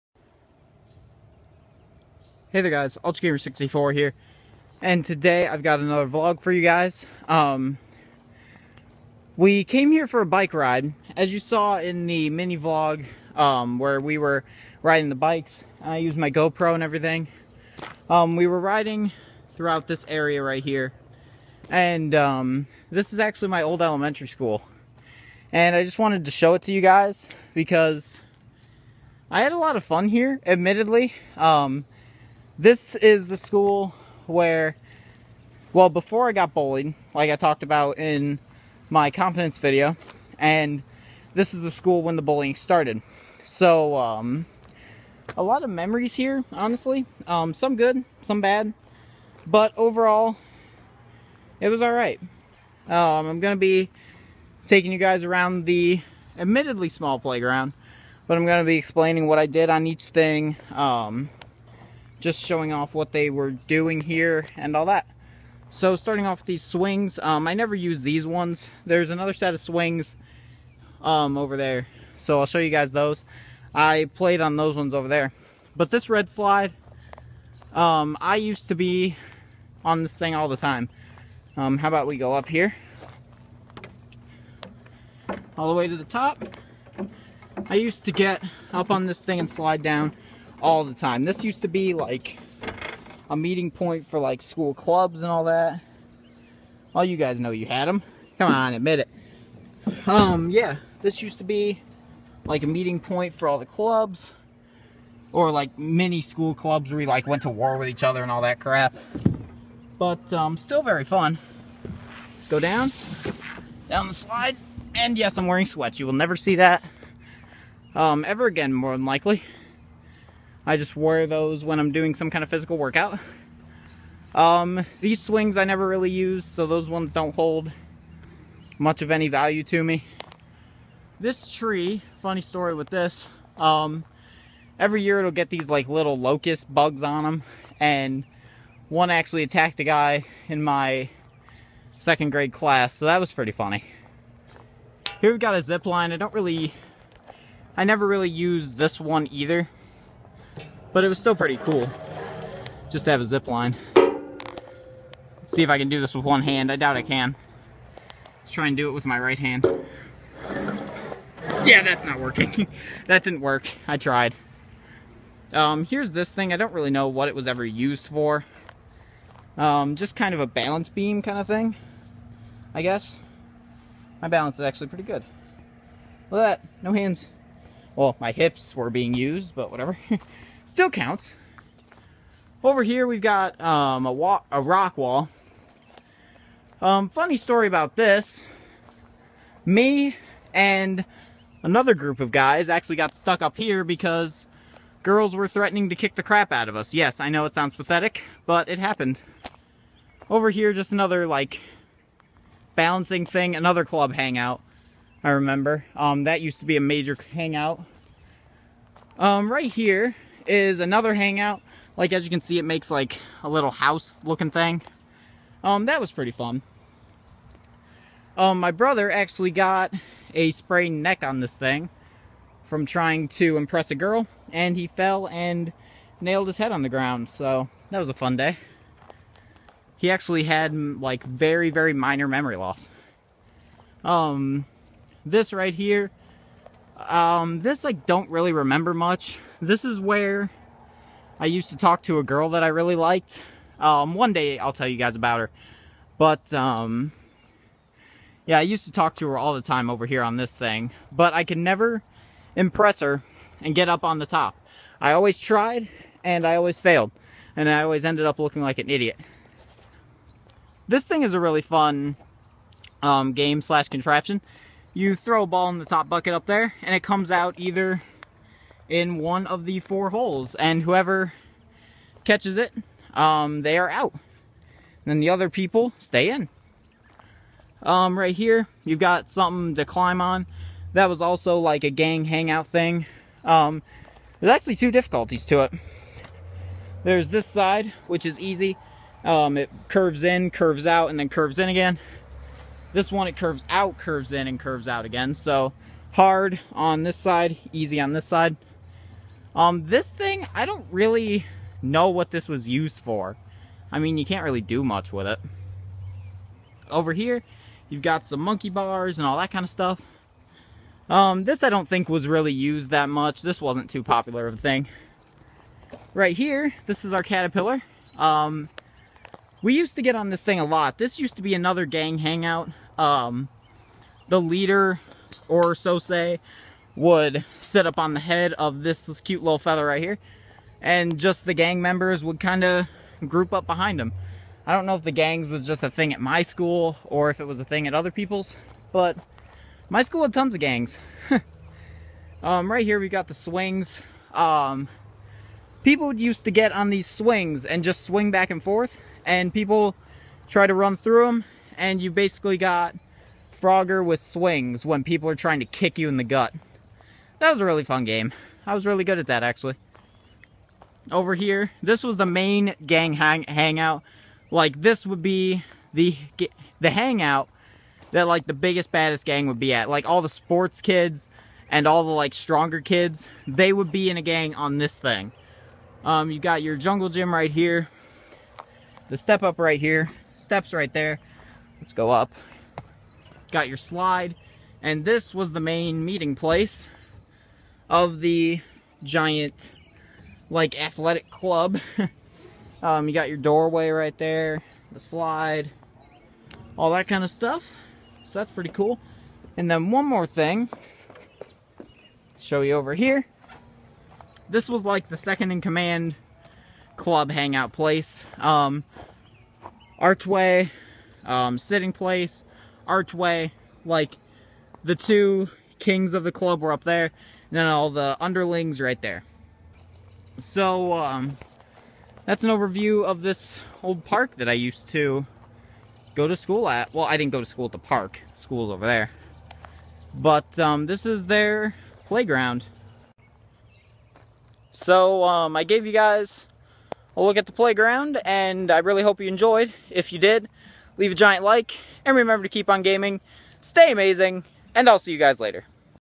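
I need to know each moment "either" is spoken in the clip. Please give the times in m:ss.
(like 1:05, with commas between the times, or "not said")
2:29, 4:27.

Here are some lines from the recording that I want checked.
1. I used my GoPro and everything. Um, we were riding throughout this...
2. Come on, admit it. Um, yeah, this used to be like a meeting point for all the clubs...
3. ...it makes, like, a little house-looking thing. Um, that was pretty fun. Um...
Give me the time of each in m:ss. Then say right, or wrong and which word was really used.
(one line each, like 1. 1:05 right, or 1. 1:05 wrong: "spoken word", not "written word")
1. 0:15 right
2. 1:38 right
3. 3:32 right.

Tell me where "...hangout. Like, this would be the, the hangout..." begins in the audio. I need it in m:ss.
6:03.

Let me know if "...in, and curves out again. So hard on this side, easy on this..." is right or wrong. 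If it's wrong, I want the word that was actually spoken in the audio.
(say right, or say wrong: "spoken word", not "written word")
right.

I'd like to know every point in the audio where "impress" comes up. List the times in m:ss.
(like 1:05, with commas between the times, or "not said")
3:43, 4:12.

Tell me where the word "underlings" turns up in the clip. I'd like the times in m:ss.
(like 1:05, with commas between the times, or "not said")
6:58.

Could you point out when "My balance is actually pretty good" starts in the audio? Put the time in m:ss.
2:54.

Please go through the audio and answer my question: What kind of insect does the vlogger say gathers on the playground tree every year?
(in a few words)
Locust bugs.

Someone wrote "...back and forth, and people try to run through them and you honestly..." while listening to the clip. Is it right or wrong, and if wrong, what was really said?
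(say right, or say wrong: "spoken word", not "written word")
wrong: "basically", not "honestly".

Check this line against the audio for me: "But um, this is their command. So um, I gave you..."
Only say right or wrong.
wrong.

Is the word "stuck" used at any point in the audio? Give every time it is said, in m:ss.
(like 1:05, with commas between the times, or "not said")
3:13.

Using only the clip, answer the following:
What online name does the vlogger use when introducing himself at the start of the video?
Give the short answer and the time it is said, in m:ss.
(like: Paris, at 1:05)
UltraGamer64, at 0:03.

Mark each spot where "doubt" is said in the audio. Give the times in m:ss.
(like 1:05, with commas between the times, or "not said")
2:36.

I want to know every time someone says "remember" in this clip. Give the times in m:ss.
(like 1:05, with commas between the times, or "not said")
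3:25, 3:58, 7:22.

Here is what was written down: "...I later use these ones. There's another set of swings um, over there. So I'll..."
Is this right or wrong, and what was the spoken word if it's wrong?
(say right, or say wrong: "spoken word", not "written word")
wrong: "never", not "later".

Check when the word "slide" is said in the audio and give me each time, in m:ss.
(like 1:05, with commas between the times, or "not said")
1:16, 1:29, 1:54, 6:23, 6:34.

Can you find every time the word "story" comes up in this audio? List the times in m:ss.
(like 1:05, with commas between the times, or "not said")
2:12, 3:07.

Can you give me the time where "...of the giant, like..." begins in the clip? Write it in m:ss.
6:27.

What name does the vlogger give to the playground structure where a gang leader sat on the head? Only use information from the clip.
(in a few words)
Caterpillar.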